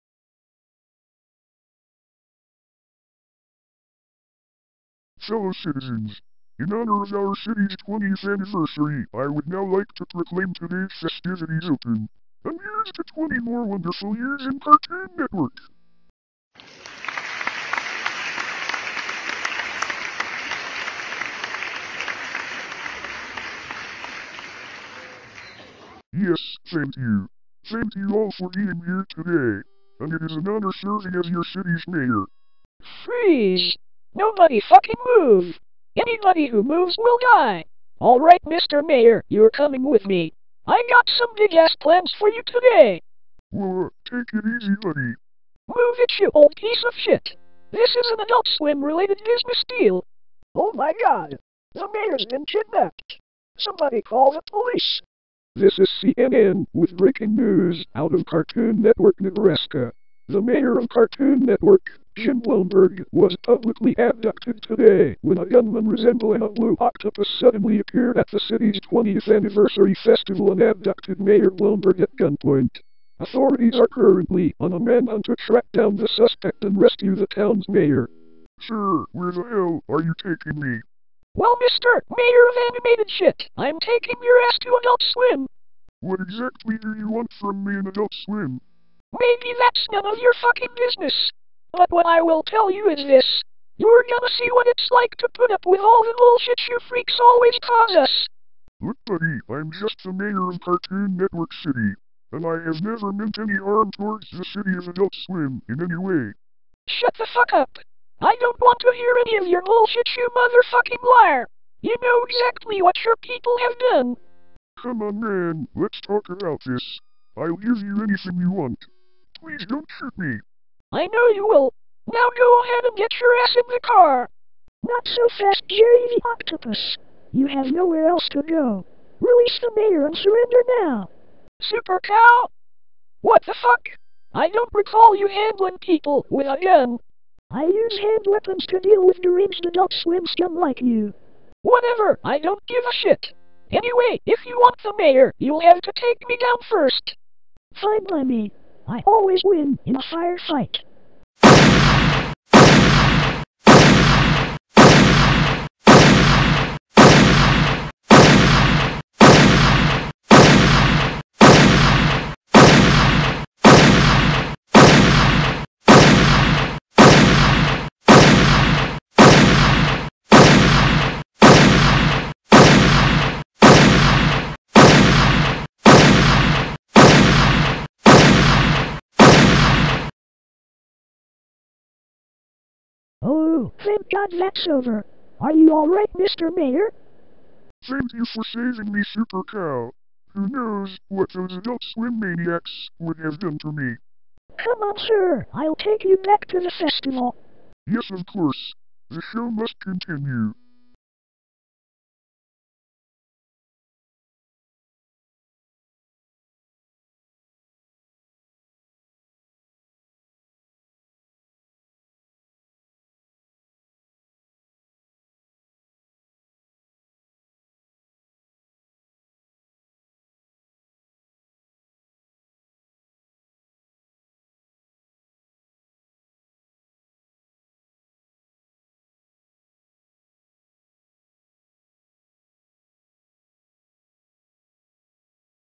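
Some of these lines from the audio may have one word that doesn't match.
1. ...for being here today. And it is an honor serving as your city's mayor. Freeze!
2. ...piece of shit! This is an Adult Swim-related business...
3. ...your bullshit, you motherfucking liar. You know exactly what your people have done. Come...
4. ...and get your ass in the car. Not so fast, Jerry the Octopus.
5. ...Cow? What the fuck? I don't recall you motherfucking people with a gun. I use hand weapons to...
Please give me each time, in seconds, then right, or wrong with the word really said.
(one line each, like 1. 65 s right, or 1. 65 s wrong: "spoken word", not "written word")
1. 28 s right
2. 46 s right
3. 109 s right
4. 122 s right
5. 132 s wrong: "handling", not "motherfucking".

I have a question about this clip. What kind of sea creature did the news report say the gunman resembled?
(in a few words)
blue octopus.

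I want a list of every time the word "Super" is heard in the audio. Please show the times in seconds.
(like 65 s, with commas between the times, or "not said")
131 s, 189 s.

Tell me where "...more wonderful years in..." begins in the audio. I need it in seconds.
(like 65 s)
13 s.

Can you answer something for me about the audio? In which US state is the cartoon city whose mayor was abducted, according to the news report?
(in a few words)
Nebraska.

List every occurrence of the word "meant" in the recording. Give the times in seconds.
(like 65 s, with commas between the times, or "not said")
103 s.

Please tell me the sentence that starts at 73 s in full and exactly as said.
Authorities are currently on a manhunt to track down the suspect and rescue the town's mayor.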